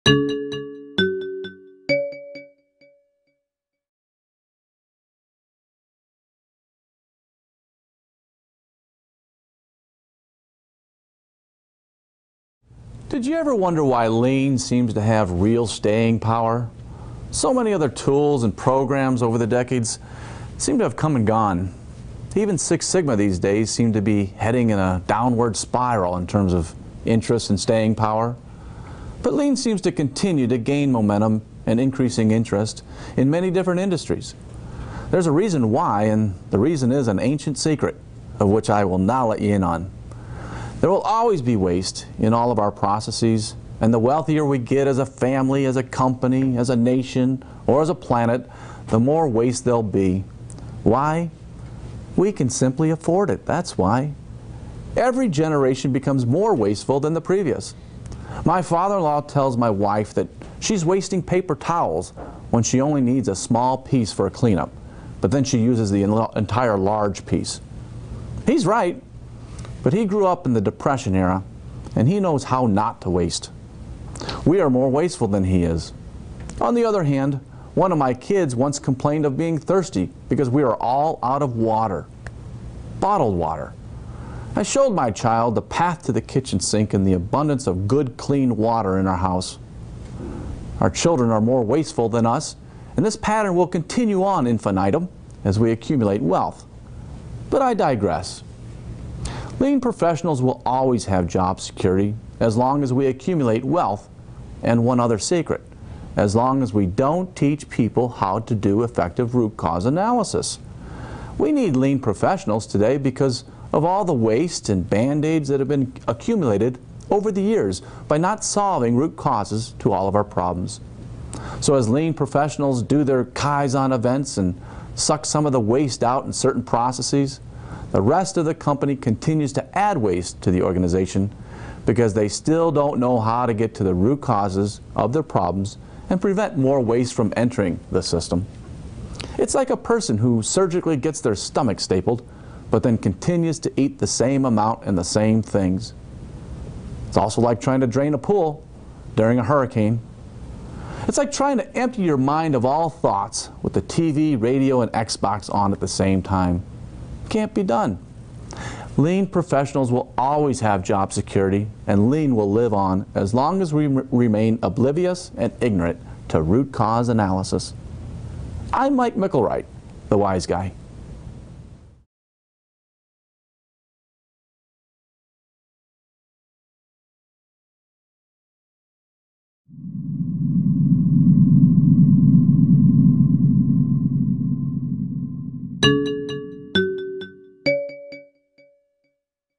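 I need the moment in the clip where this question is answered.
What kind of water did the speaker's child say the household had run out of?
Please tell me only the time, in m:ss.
1:22.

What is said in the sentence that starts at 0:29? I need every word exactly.
But lean seems to continue to gain momentum and increasing interest in many different industries.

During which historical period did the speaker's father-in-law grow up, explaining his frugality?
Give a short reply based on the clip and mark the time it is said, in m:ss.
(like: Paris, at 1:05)
the Depression era, at 1:10.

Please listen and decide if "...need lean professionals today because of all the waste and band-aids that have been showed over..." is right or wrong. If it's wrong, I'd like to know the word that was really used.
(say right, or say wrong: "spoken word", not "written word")
wrong: "accumulated", not "showed".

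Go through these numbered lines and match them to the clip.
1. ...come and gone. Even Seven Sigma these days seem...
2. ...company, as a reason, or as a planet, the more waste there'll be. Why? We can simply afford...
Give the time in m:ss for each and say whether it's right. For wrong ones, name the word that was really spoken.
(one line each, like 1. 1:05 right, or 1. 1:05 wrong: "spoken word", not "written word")
1. 0:20 wrong: "Six", not "Seven"
2. 0:45 wrong: "nation", not "reason".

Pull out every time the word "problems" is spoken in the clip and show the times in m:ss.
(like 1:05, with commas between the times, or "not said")
2:00, 2:15.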